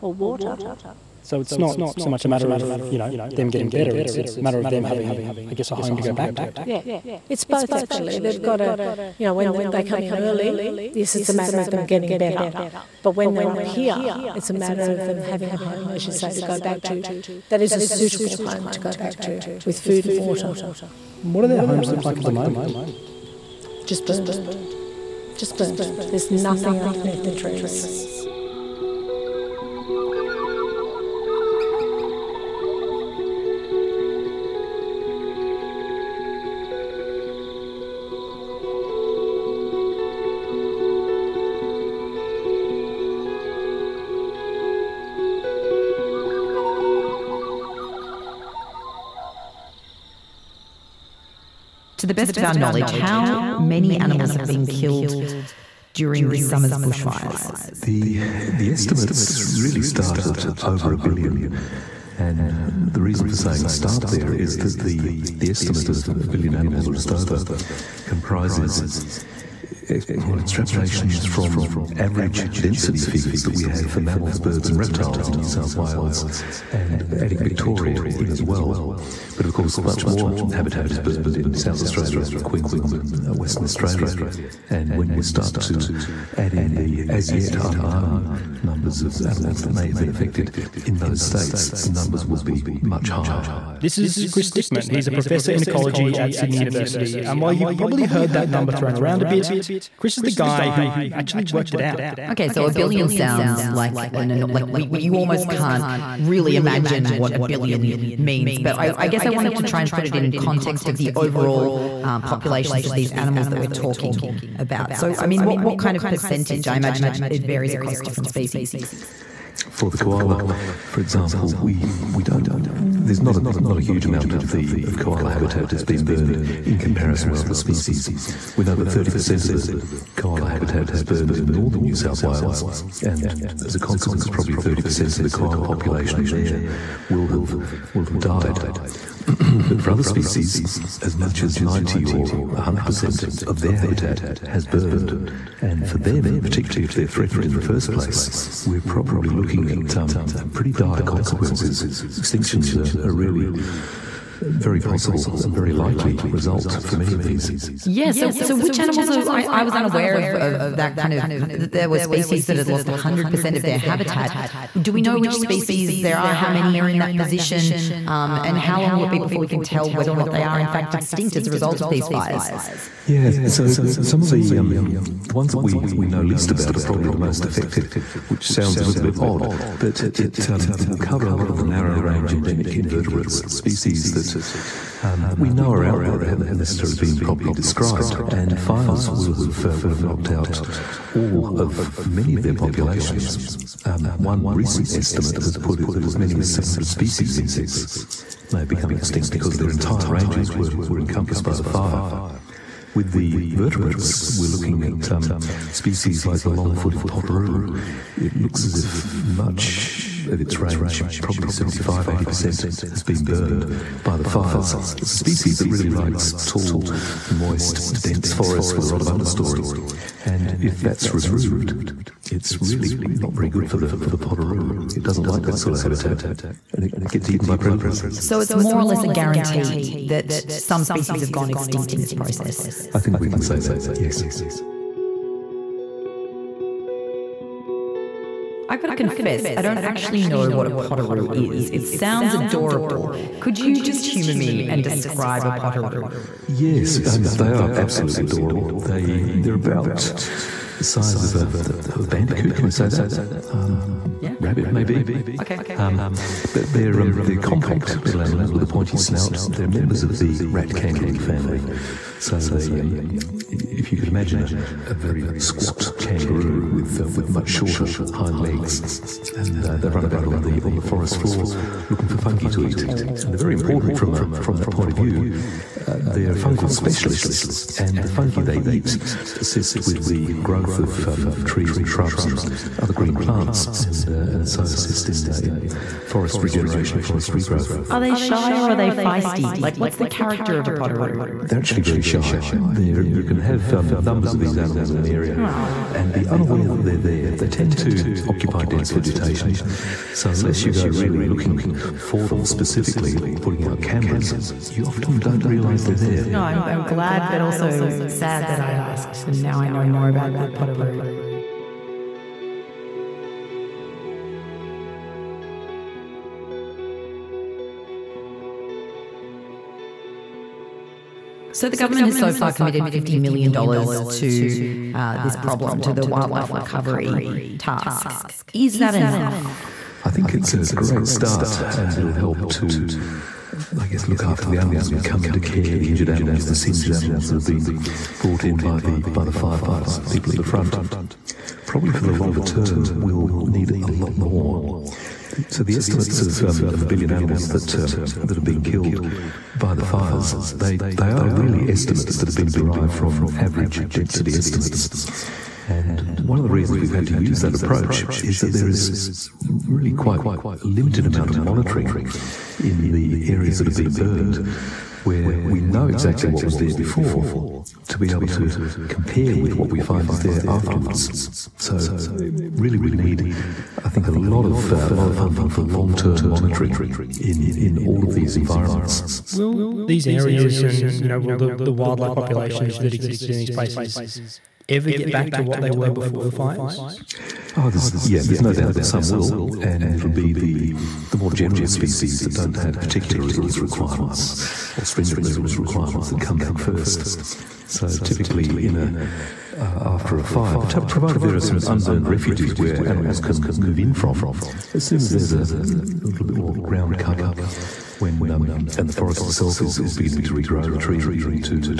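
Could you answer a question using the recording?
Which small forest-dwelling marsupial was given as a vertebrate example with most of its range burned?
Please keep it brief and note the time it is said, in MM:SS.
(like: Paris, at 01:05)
Long-footed potoroo, at 03:26.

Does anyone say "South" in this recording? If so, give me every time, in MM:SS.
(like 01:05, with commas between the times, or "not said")
01:15, 01:21, 02:11.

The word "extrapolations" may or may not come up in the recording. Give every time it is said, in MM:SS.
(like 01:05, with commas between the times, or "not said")
01:10.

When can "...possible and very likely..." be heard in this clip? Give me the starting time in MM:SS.
02:34.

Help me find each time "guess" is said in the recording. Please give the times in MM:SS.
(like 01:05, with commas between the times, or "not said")
00:05, 01:49, 05:33.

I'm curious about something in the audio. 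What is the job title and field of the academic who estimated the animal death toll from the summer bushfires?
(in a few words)
Professor in ecology.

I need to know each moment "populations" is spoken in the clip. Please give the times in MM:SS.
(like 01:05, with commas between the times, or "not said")
01:52, 02:15, 03:12, 06:22.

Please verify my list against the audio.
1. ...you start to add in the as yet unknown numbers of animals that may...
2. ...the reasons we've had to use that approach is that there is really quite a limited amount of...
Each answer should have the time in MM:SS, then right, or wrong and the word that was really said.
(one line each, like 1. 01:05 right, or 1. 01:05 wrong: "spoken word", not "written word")
1. 01:25 right
2. 05:56 right.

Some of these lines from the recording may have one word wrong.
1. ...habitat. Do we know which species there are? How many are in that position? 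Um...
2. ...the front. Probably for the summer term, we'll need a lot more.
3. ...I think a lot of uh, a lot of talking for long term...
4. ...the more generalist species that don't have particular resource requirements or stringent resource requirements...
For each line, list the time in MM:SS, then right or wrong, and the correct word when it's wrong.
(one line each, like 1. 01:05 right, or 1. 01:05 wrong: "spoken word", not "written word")
1. 02:43 right
2. 05:40 wrong: "longer", not "summer"
3. 06:13 wrong: "funding", not "talking"
4. 06:31 right.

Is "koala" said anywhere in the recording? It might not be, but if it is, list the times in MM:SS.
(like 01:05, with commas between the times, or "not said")
01:59, 02:04, 02:10, 02:15.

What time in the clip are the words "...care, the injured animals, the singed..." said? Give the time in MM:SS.
05:35.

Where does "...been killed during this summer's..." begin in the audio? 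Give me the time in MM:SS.
00:54.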